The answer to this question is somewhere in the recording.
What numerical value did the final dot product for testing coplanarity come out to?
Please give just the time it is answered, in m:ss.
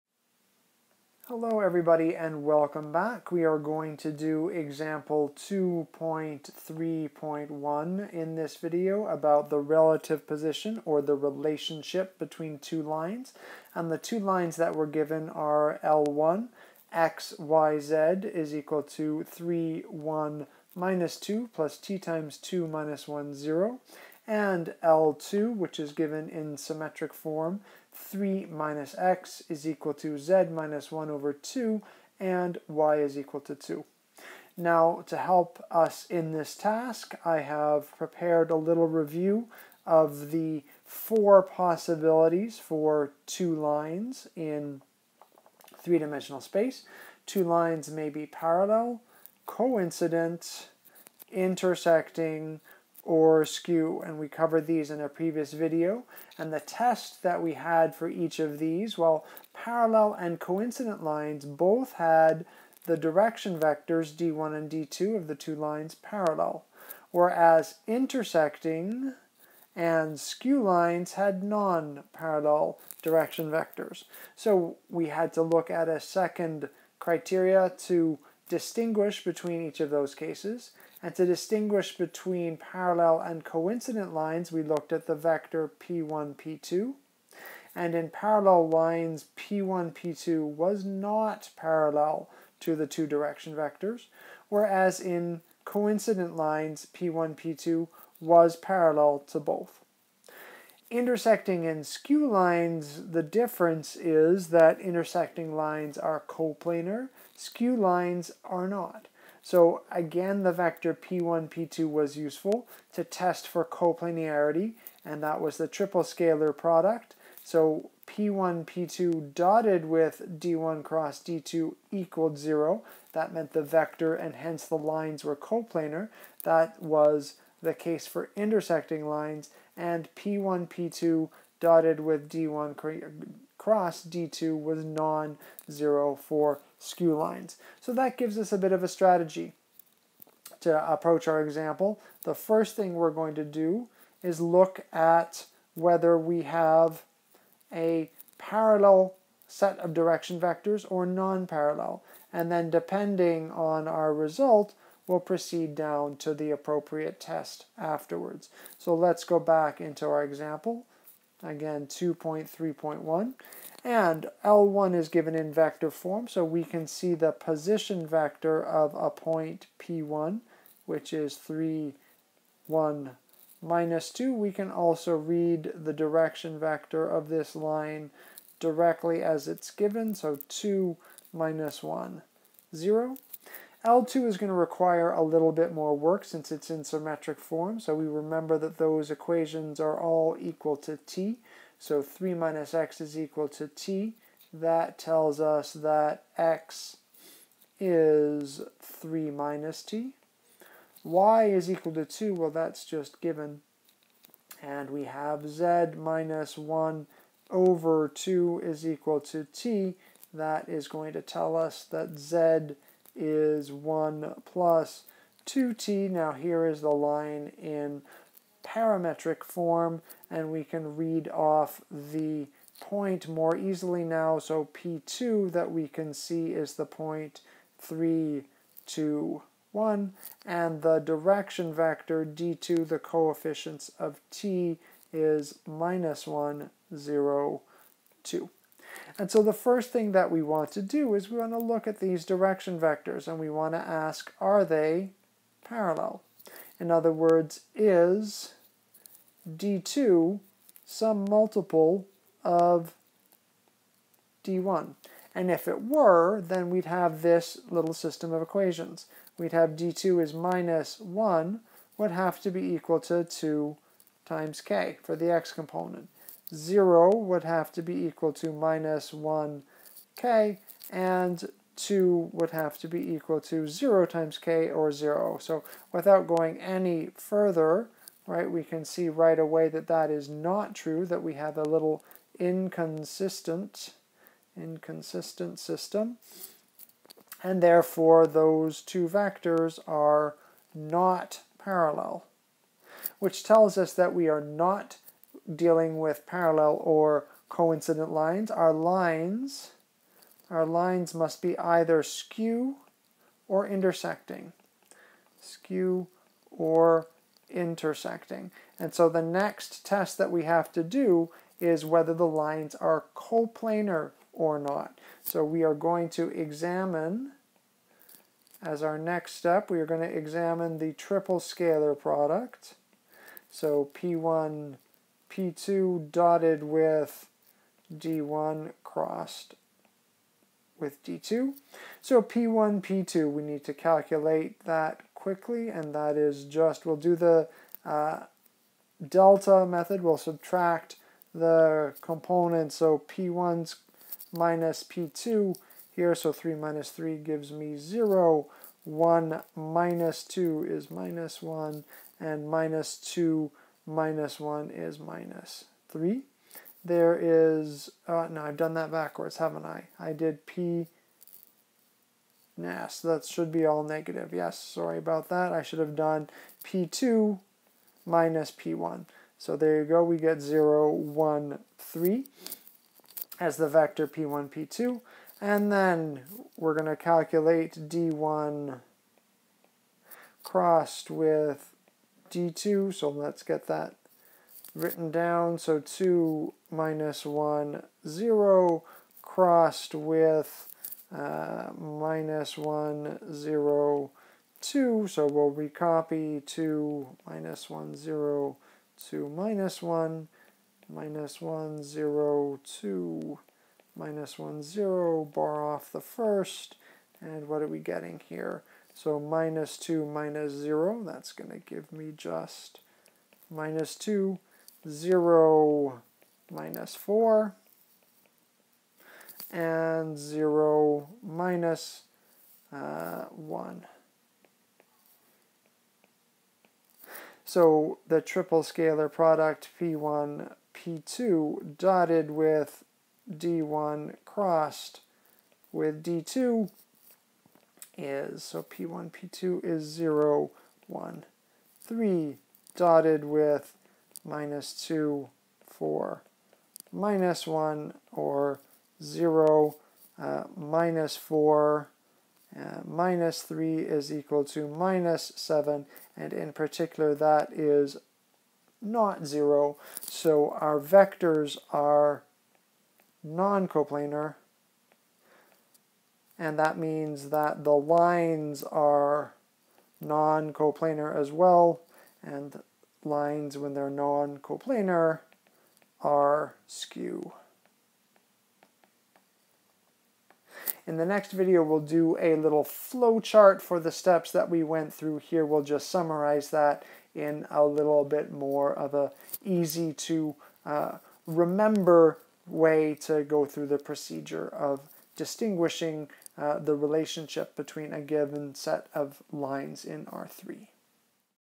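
7:34.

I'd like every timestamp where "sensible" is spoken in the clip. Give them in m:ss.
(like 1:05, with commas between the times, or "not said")
not said.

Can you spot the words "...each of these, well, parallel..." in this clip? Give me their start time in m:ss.
0:58.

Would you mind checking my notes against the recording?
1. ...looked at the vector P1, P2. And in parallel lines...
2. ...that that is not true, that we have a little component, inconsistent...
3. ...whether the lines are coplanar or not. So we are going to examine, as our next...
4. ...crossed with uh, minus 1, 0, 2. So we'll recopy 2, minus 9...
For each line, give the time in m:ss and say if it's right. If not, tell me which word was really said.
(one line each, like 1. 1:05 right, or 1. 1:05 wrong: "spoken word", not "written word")
1. 1:24 right
2. 4:39 wrong: "inconsistent", not "component"
3. 5:11 right
4. 6:29 wrong: "1", not "9".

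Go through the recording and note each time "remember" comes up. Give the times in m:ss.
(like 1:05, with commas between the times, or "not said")
3:08, 8:11.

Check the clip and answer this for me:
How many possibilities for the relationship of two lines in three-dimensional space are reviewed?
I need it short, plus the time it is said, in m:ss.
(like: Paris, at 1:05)
4, at 0:40.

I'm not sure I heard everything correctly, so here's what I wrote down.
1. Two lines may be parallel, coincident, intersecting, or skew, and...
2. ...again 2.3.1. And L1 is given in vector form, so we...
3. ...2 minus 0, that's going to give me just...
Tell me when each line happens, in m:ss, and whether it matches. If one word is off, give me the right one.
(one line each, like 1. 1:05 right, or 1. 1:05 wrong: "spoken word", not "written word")
1. 0:47 right
2. 2:41 right
3. 6:49 right.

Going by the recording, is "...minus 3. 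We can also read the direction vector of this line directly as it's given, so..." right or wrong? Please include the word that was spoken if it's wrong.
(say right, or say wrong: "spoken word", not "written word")
wrong: "2", not "3".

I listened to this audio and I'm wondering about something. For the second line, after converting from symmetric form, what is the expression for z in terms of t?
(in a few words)
1 + 2t.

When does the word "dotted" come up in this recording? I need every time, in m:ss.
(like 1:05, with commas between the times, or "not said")
1:59, 2:11, 5:26, 7:11, 7:22.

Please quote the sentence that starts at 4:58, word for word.
Our lines, our lines must be either skew or intersecting.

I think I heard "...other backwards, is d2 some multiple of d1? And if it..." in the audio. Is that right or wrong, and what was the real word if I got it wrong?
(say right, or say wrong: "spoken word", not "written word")
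wrong: "words", not "backwards".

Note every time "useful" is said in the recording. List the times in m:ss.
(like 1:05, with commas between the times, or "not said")
1:52.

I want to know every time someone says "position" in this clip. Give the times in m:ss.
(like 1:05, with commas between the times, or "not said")
0:10, 2:47.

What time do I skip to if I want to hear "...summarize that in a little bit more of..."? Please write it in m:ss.
8:05.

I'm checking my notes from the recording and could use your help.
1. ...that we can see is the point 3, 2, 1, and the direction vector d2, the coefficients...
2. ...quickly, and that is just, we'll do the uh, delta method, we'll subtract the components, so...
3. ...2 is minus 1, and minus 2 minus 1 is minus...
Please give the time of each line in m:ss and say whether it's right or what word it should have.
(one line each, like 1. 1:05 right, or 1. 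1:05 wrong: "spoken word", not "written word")
1. 3:45 right
2. 5:35 right
3. 5:50 right.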